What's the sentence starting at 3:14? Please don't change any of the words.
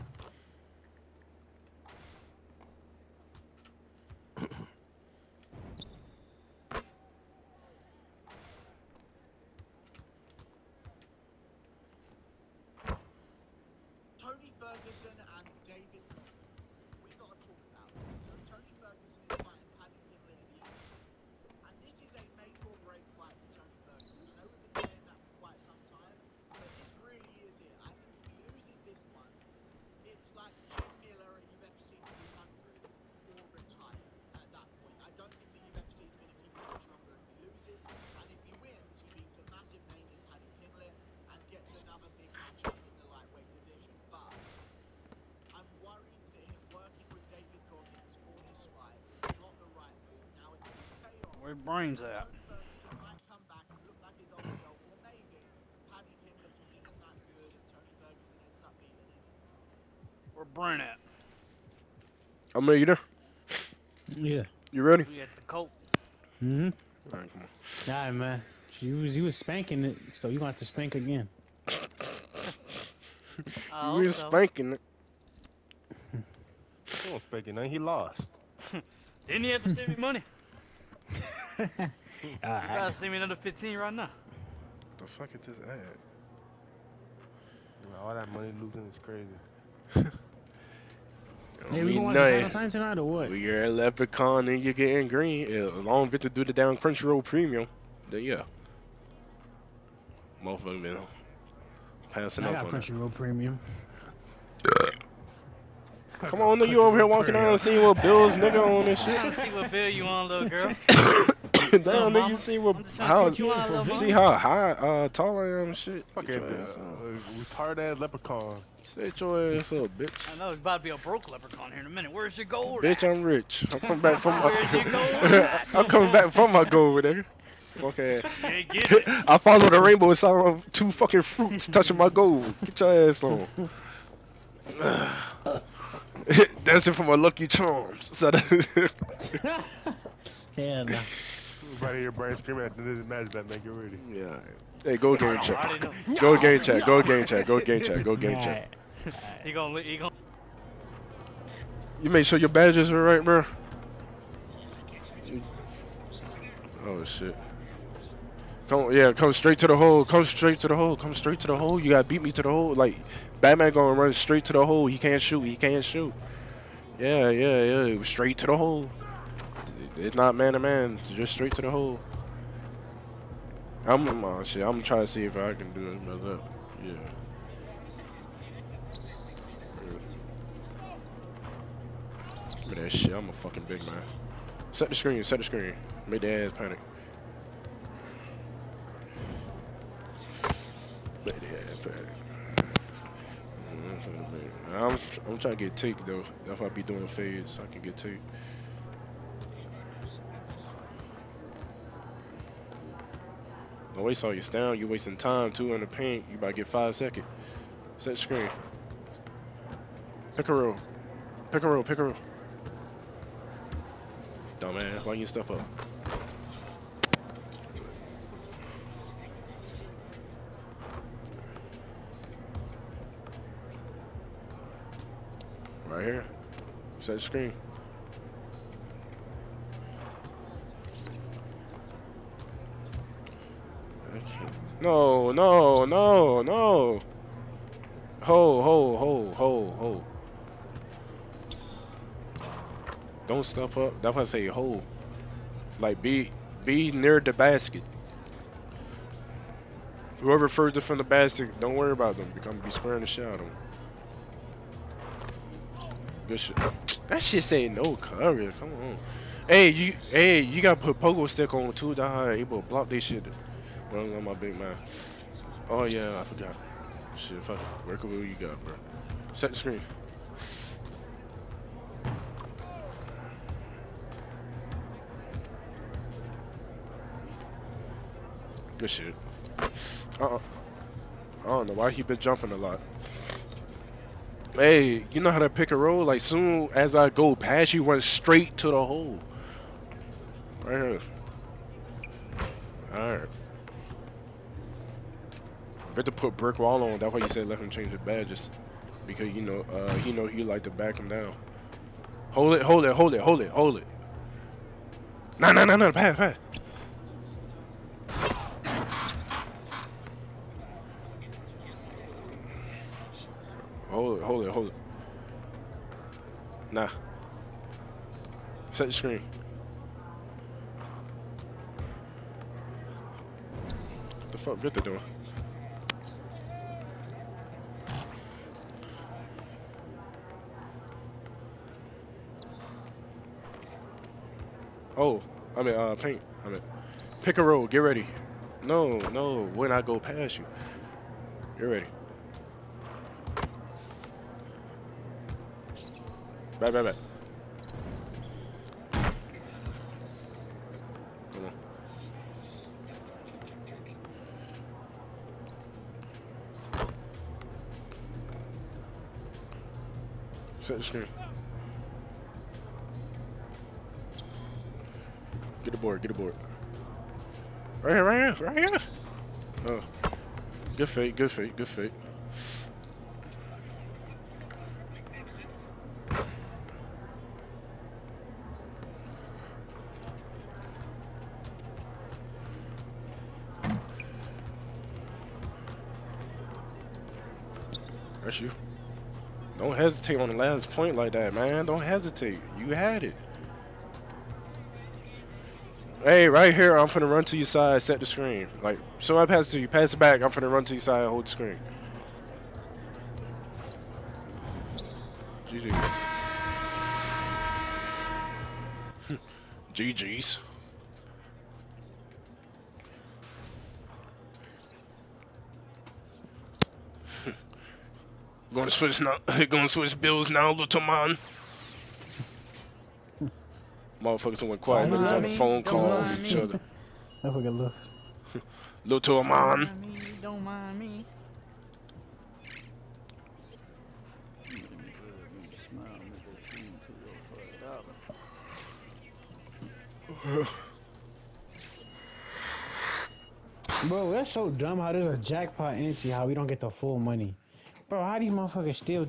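I'm, I'm trying to get take though.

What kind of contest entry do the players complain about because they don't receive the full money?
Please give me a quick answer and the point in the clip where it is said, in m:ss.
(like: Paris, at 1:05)
jackpot entry, at 7:25.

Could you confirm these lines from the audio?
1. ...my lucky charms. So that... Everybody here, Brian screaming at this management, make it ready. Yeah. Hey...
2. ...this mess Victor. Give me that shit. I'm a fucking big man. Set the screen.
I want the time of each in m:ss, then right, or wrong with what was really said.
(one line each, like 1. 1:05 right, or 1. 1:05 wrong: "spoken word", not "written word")
1. 2:17 right
2. 2:55 wrong: "Yeah", not "Victor".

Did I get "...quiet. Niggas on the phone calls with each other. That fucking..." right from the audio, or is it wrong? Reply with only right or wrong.
right.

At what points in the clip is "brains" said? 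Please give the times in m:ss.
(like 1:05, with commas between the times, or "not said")
0:51, 1:00.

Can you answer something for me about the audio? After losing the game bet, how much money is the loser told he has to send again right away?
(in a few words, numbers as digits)
15.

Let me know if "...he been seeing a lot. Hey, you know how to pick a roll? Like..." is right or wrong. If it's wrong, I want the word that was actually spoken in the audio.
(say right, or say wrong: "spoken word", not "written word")
wrong: "jumping", not "seeing".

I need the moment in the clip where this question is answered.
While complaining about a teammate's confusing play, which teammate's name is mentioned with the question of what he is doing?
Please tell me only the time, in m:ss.
5:24.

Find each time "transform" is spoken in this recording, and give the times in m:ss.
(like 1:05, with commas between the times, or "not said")
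not said.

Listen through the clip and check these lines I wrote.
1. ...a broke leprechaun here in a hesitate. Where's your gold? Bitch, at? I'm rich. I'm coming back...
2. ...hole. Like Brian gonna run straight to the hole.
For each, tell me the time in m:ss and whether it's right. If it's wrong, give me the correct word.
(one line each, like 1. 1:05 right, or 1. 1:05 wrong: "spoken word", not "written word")
1. 2:00 wrong: "minute", not "hesitate"
2. 2:42 wrong: "Batman", not "Brian".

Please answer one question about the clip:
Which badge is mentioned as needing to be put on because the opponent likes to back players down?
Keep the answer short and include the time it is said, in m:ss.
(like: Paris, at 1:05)
brick wall, at 4:56.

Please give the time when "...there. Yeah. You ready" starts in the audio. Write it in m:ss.
1:02.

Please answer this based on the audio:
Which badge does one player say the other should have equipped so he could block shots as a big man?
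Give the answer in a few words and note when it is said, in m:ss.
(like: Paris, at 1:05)
pogo stick, at 4:20.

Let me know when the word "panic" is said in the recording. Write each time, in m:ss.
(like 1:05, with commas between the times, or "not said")
3:06, 3:11.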